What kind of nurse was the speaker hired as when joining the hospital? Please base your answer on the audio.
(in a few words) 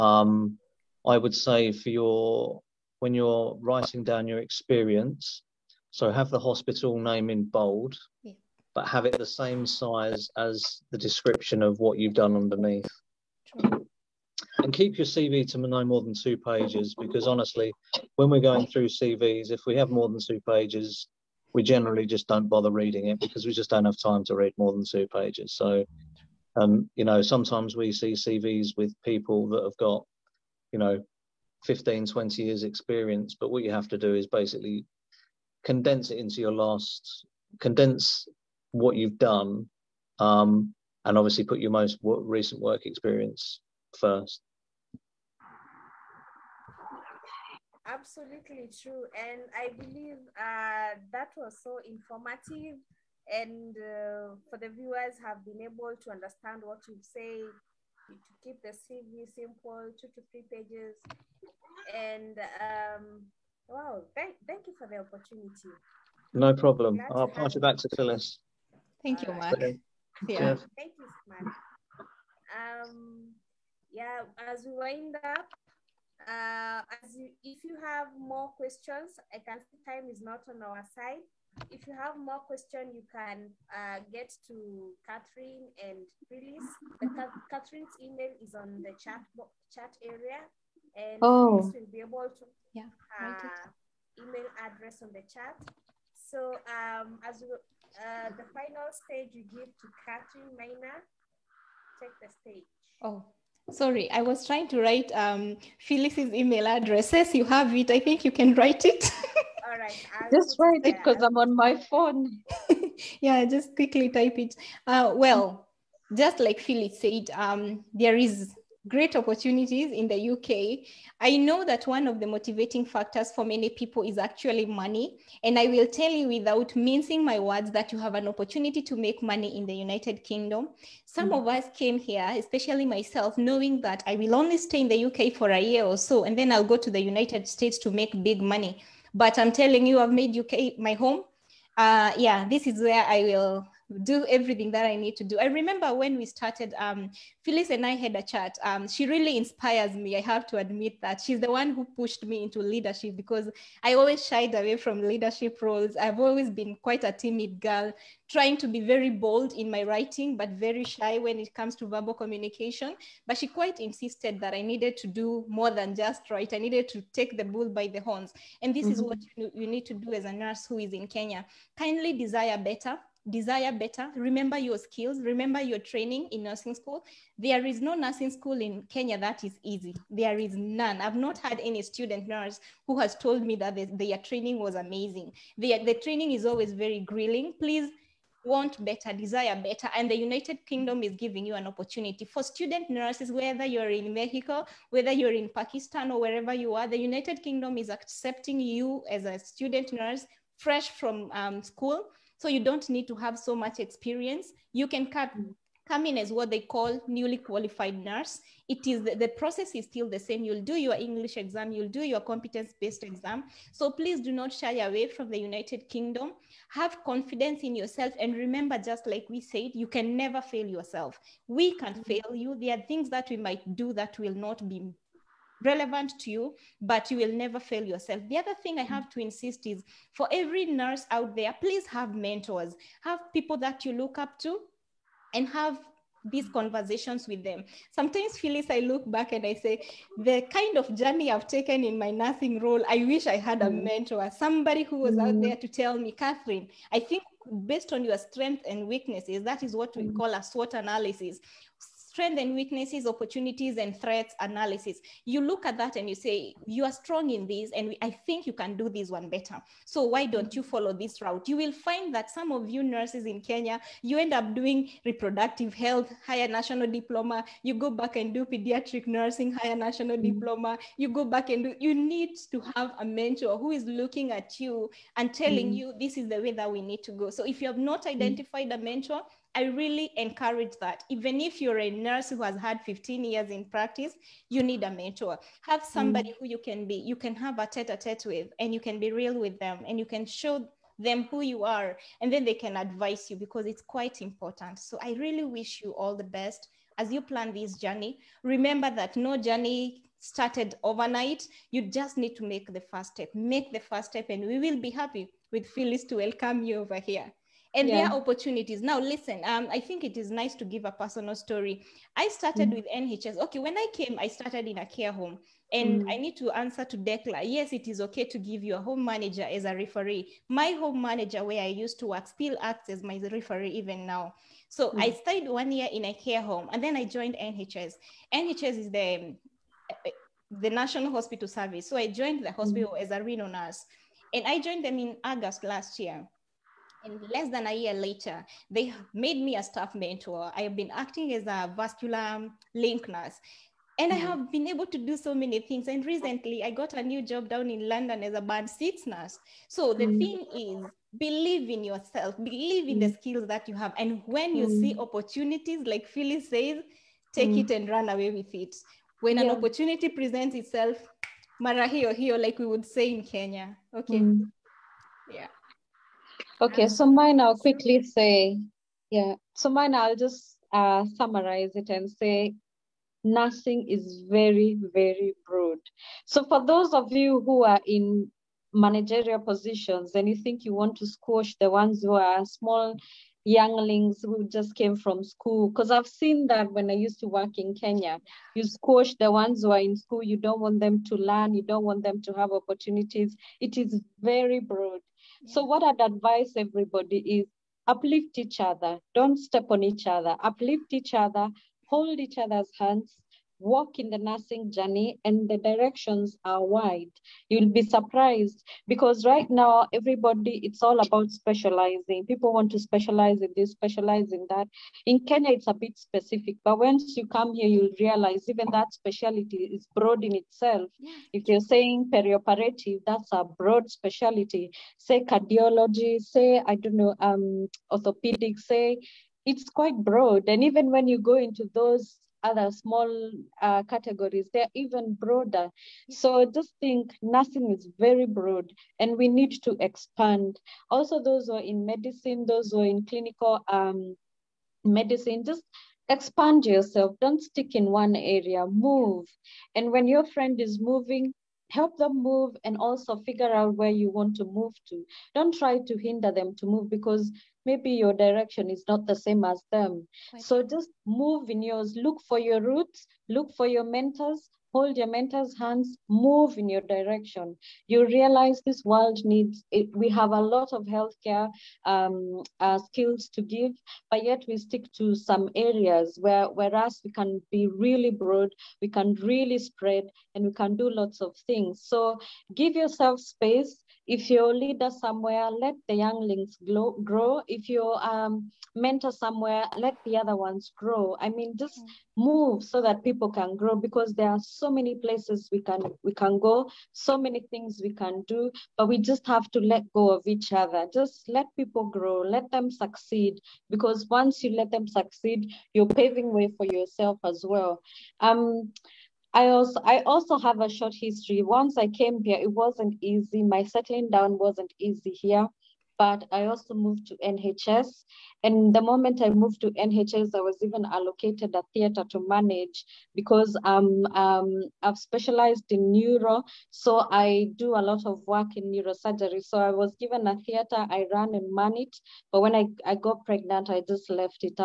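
Renal nurse.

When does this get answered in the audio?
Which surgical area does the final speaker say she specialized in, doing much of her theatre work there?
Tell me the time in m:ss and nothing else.
8:48.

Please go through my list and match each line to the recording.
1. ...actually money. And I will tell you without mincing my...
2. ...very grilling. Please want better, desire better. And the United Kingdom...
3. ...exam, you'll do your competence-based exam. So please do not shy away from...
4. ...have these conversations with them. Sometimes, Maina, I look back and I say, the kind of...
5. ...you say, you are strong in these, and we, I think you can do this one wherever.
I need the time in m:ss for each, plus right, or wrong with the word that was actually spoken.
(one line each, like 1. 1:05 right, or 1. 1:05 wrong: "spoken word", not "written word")
1. 2:04 right
2. 3:06 right
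3. 3:31 right
4. 3:55 wrong: "Phyllis", not "Maina"
5. 4:16 wrong: "better", not "wherever".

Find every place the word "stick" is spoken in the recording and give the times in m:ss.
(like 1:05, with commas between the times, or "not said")
7:27, 7:54.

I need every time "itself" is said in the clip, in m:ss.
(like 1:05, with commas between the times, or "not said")
6:00, 7:00.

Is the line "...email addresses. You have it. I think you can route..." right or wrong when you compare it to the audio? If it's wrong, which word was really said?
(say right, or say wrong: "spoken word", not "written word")
wrong: "write", not "route".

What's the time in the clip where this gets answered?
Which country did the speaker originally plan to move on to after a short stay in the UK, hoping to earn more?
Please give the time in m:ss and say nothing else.
2:16.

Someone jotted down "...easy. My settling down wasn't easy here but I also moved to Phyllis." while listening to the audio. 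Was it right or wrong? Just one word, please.
wrong.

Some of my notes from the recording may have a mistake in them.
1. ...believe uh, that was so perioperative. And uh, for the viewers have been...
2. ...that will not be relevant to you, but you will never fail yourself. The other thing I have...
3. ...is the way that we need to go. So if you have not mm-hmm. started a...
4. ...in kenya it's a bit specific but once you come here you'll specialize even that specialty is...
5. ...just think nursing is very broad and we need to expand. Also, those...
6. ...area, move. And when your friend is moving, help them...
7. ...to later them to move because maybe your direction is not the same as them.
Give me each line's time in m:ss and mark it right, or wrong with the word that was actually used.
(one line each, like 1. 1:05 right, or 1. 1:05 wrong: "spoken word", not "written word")
1. 0:49 wrong: "informative", not "perioperative"
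2. 3:43 right
3. 4:36 wrong: "identified", not "started"
4. 6:55 wrong: "realize", not "specialize"
5. 7:16 right
6. 7:28 right
7. 7:35 wrong: "hinder", not "later".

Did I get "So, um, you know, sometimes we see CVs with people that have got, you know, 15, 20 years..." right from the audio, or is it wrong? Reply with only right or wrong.
right.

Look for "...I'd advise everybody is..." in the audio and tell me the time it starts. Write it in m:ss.
6:35.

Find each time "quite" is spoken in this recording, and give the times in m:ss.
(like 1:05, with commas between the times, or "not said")
2:36, 2:43, 4:53, 7:09.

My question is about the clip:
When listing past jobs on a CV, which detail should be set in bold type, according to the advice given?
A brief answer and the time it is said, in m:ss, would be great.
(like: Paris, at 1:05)
Hospital name, at 0:06.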